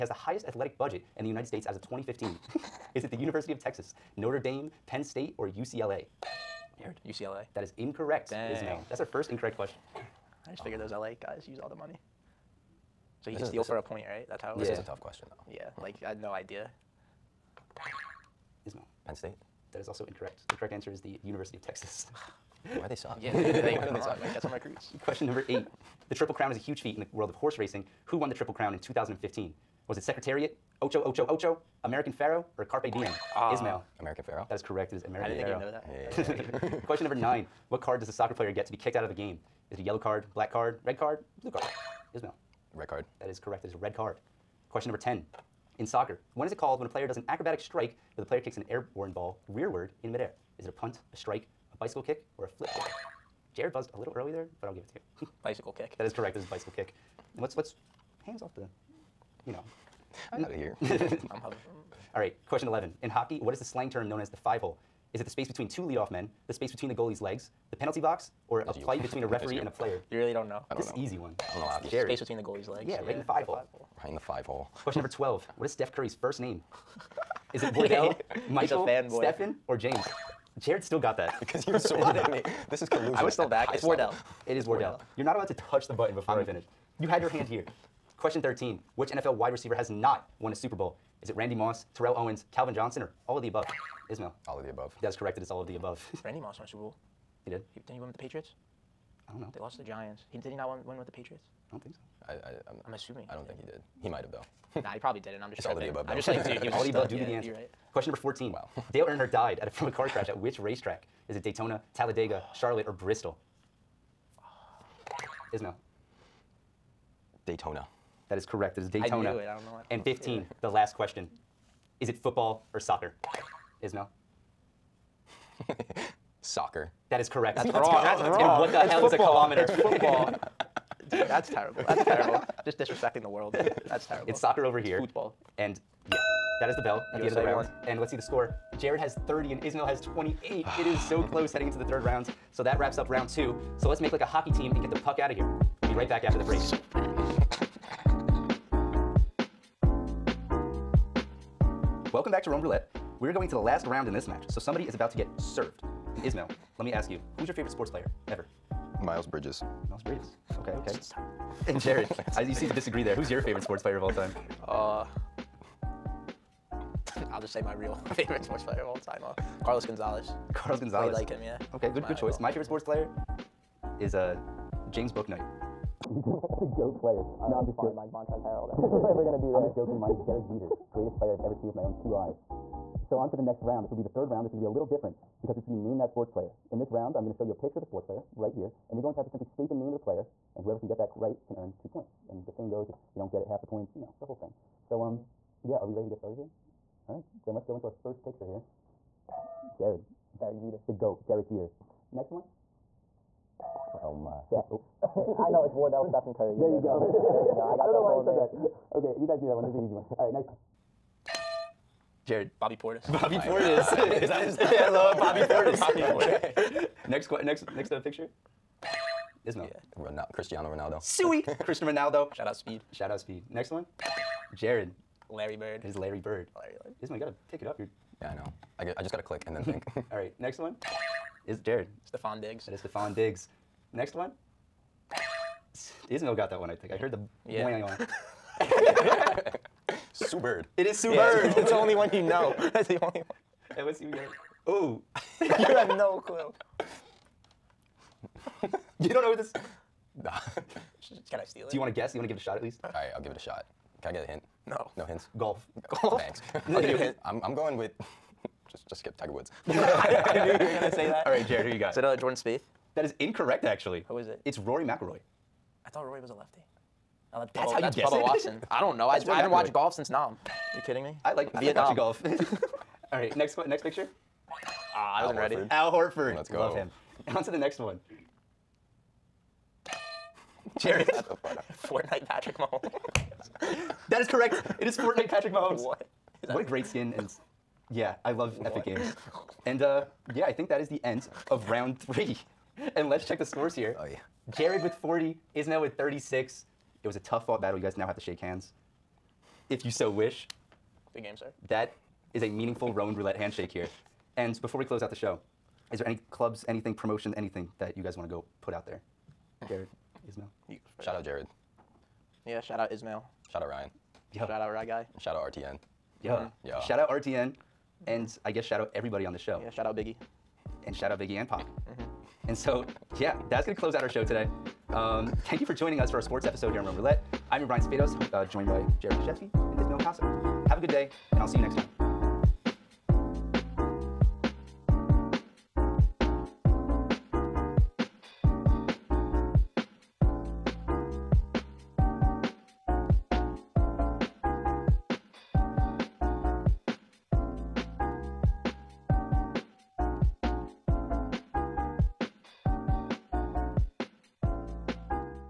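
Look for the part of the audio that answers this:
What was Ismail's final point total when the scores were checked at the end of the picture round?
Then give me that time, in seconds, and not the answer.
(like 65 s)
295 s.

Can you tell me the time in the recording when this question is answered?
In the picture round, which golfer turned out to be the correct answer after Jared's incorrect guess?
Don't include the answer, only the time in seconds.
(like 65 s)
264 s.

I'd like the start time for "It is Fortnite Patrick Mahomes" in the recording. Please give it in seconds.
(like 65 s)
284 s.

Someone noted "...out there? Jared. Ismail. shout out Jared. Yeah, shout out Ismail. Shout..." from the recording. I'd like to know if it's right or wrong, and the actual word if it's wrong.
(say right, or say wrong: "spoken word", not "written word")
right.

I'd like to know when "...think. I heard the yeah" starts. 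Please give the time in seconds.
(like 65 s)
236 s.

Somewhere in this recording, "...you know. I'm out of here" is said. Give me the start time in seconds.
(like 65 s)
59 s.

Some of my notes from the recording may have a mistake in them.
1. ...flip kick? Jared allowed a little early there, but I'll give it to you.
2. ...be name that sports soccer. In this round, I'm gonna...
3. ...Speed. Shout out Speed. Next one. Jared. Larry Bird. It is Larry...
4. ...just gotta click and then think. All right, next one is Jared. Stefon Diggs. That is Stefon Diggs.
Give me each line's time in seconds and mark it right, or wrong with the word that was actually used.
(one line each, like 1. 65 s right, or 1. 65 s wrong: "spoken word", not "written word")
1. 52 s wrong: "buzzed", not "allowed"
2. 185 s wrong: "player", not "soccer"
3. 222 s right
4. 229 s right.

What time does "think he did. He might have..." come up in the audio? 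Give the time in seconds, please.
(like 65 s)
103 s.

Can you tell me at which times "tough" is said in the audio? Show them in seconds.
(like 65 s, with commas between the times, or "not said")
14 s, 297 s.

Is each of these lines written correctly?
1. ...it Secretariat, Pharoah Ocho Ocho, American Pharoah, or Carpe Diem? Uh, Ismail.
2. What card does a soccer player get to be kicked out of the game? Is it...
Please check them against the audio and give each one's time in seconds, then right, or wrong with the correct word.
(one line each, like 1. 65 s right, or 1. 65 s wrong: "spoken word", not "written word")
1. 29 s wrong: "Ocho", not "Pharoah"
2. 37 s right.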